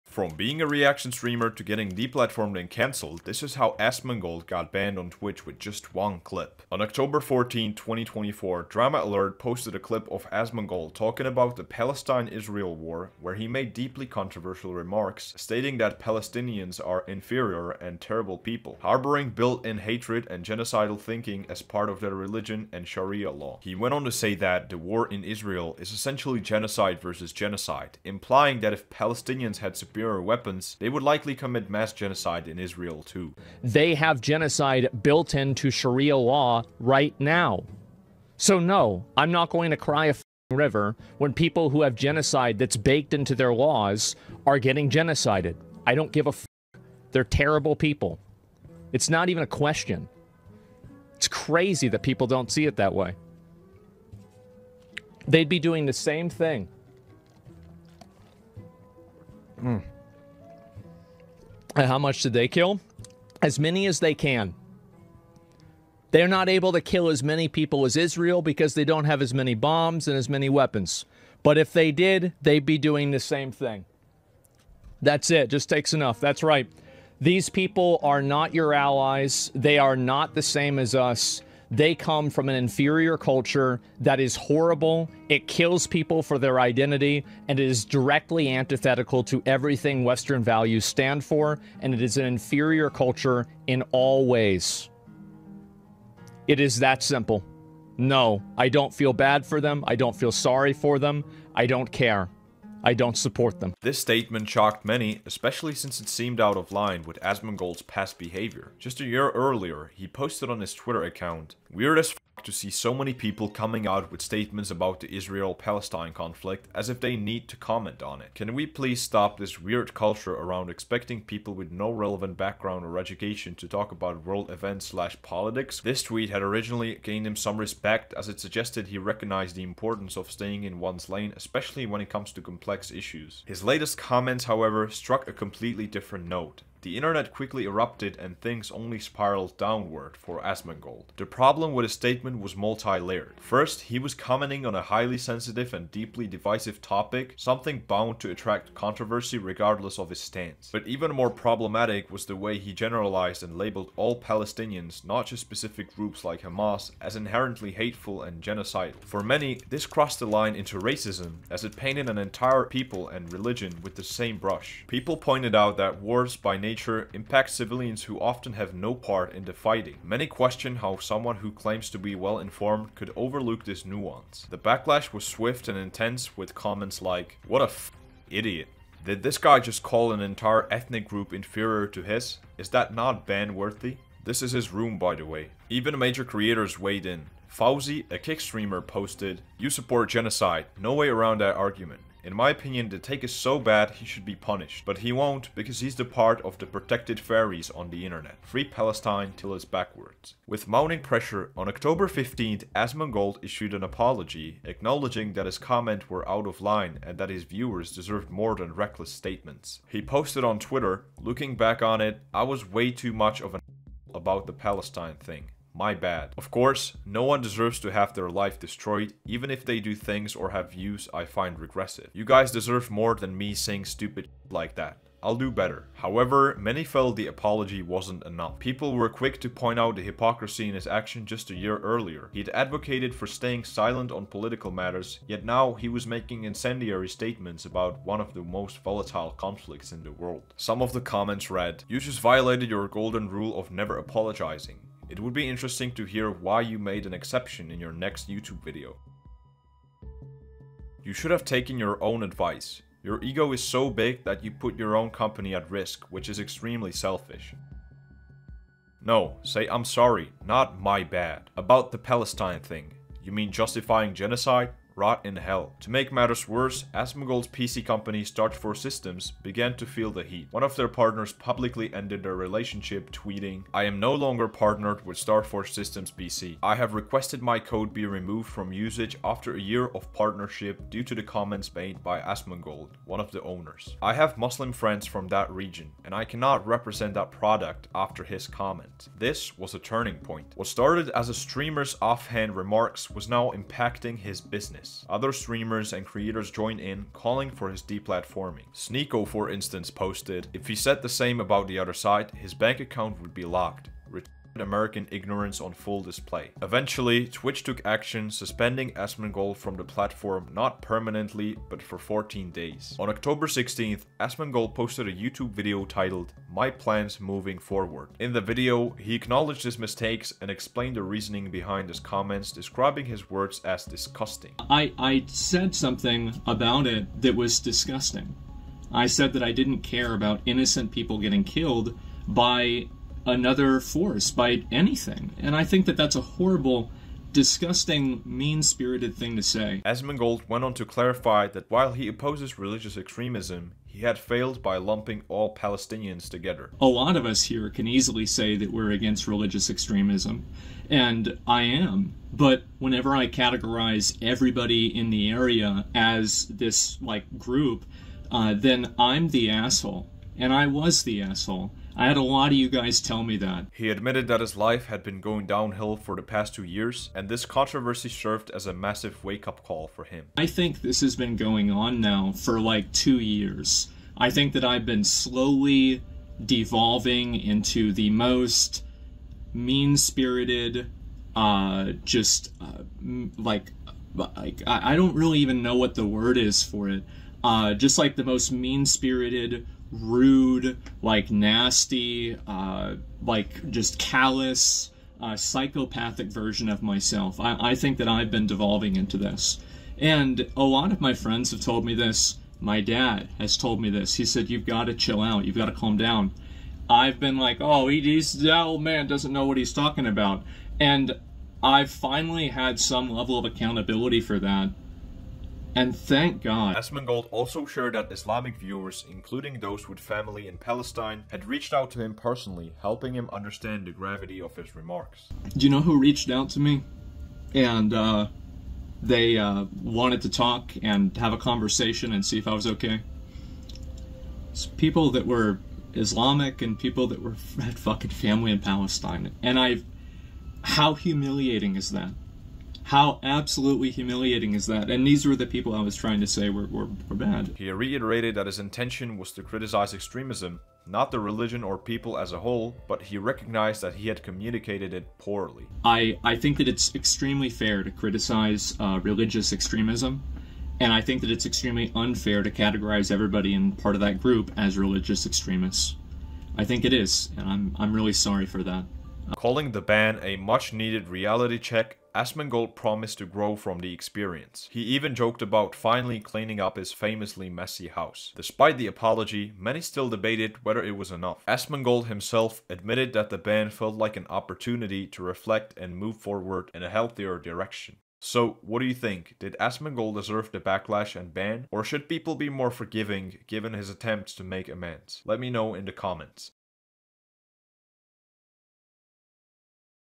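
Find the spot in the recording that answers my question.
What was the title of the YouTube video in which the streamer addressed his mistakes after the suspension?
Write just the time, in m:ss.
5:16.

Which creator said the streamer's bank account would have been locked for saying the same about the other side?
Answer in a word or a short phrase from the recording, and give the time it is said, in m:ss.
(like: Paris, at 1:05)
Sneako, at 4:58.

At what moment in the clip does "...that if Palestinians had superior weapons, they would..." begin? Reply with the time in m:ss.
0:28.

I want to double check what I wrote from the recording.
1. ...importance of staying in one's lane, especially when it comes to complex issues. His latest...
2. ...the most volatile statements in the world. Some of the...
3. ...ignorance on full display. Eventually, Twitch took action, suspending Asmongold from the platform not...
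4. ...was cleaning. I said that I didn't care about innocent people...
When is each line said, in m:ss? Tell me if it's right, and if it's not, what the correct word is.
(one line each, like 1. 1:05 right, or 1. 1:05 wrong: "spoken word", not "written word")
1. 2:09 right
2. 3:58 wrong: "conflicts", not "statements"
3. 5:05 right
4. 5:27 wrong: "disgusting", not "cleaning".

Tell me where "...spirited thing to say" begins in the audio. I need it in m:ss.
5:38.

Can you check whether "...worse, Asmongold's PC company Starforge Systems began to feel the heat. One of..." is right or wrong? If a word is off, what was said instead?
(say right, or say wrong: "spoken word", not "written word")
right.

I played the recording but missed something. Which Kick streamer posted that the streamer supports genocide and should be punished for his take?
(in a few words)
Fousey.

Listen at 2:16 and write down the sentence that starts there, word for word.
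The internet quickly erupted and things only spiraled downward for Asmongold.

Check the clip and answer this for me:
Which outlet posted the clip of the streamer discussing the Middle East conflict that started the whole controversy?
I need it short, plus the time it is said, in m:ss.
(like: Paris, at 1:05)
Drama Alert, at 0:08.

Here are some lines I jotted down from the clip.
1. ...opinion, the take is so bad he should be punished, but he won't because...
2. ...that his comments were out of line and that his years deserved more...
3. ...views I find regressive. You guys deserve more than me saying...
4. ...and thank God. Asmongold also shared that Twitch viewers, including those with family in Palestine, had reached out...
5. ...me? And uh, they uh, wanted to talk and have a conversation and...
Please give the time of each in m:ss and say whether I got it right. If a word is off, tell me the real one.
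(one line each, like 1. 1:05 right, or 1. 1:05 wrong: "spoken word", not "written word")
1. 3:12 right
2. 3:25 wrong: "viewers", not "years"
3. 3:40 right
4. 6:55 wrong: "Islamic", not "Twitch"
5. 7:06 right.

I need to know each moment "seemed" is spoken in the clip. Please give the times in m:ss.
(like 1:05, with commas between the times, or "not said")
1:46.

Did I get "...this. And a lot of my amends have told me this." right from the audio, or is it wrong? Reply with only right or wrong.
wrong.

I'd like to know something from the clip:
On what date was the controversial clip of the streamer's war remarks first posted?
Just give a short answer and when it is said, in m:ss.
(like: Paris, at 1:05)
October 14, 2024, at 0:06.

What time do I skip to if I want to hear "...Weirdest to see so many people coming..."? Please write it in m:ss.
1:51.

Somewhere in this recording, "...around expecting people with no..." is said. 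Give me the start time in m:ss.
2:00.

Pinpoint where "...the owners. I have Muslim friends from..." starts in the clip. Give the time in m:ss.
4:43.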